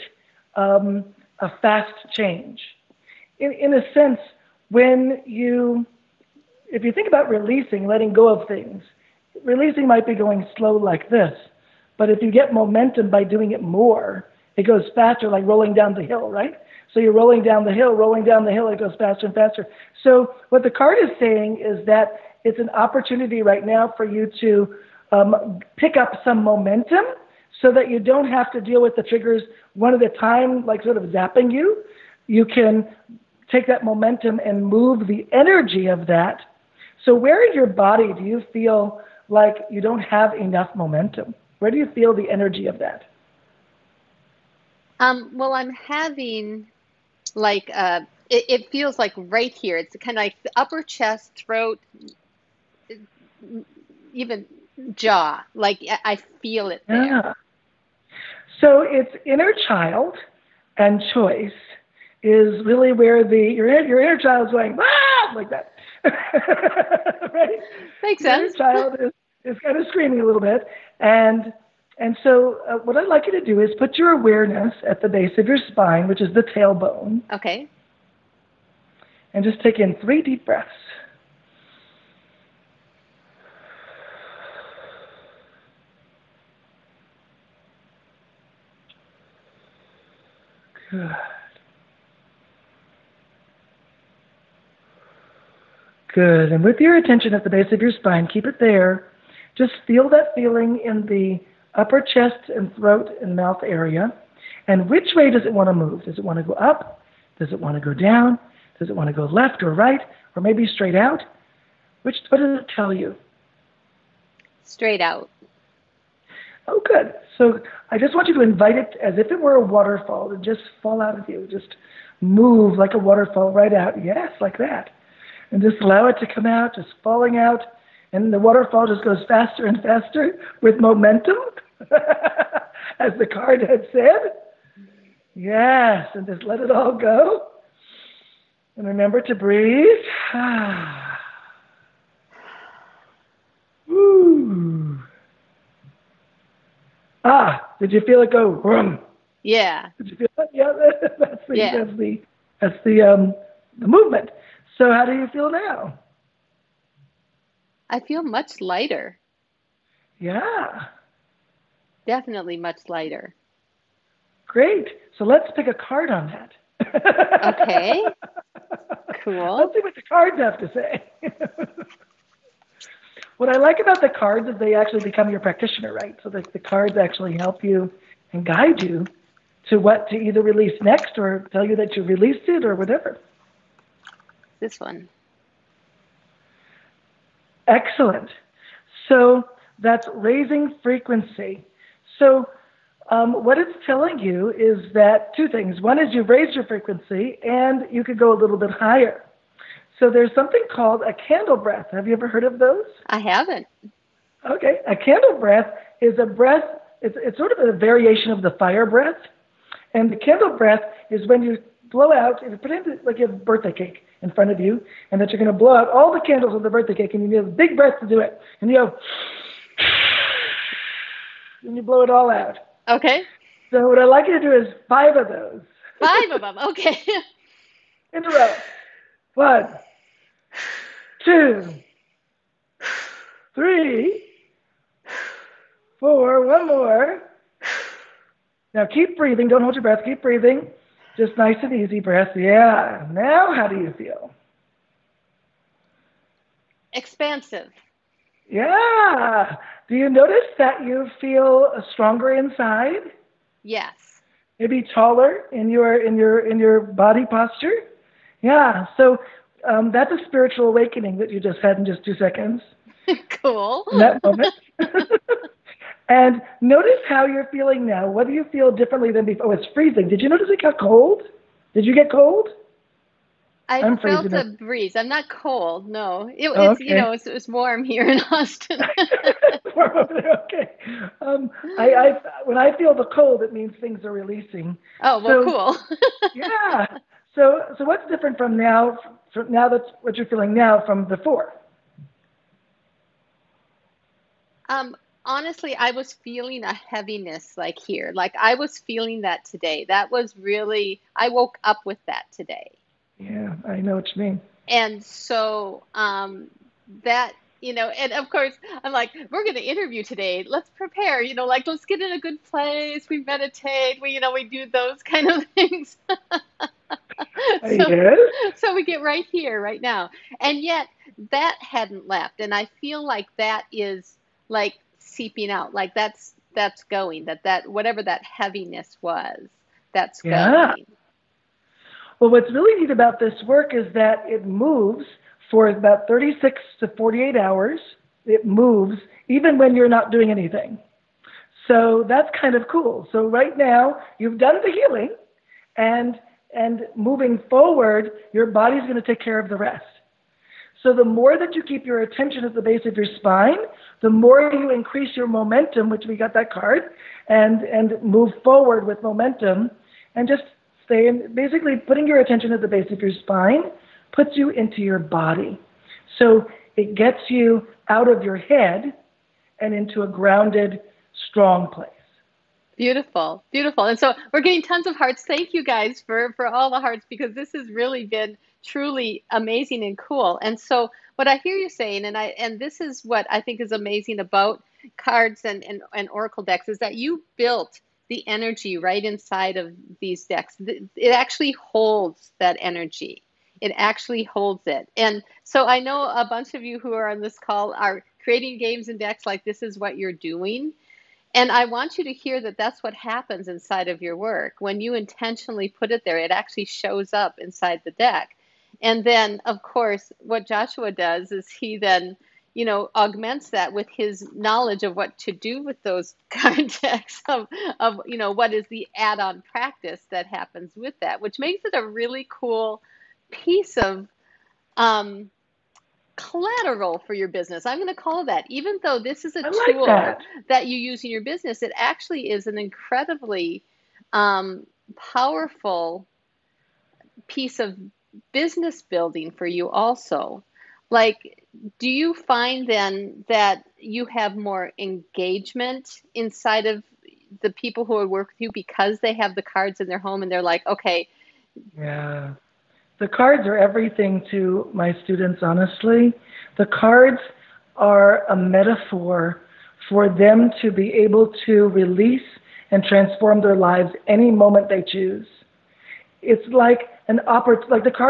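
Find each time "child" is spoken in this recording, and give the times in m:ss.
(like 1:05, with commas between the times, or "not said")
0:59, 1:04, 1:08.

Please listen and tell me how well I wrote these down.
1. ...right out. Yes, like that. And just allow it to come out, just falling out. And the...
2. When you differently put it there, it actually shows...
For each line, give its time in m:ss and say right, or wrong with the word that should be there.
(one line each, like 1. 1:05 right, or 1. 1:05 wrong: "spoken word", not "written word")
1. 2:03 right
2. 6:44 wrong: "intentionally", not "differently".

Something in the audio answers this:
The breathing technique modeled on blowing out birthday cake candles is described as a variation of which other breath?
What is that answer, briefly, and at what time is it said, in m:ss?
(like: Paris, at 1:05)
fire breath, at 3:28.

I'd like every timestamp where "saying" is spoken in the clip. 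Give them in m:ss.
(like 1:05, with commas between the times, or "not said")
0:21, 6:21.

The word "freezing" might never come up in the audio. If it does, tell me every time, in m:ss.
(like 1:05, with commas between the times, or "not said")
4:29.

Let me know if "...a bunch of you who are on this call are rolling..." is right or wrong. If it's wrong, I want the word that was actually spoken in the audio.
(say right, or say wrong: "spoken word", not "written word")
wrong: "creating", not "rolling".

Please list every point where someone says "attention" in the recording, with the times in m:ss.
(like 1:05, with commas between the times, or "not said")
1:36, 5:52, 6:02.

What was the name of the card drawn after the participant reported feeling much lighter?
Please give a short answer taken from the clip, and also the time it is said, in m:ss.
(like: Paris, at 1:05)
raising frequency, at 3:10.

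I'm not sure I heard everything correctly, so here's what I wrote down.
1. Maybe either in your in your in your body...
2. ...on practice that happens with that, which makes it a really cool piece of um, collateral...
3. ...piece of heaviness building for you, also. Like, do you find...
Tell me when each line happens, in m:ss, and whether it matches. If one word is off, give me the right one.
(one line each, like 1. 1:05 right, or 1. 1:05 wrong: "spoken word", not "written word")
1. 4:14 wrong: "taller", not "either"
2. 6:59 right
3. 7:17 wrong: "business", not "heaviness".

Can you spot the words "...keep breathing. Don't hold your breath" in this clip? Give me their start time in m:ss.
3:58.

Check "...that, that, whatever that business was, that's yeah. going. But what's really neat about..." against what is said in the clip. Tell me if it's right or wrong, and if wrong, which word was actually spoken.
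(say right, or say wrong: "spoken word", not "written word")
wrong: "heaviness", not "business".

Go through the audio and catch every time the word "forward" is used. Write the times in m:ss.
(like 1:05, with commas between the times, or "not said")
5:47, 5:58.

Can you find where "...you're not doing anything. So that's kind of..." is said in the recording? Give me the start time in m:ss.
5:39.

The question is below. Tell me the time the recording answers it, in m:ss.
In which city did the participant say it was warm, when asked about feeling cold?
4:38.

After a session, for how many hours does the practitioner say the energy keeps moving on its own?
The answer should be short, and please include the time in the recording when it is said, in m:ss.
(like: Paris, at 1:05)
36 to 48 hours, at 5:36.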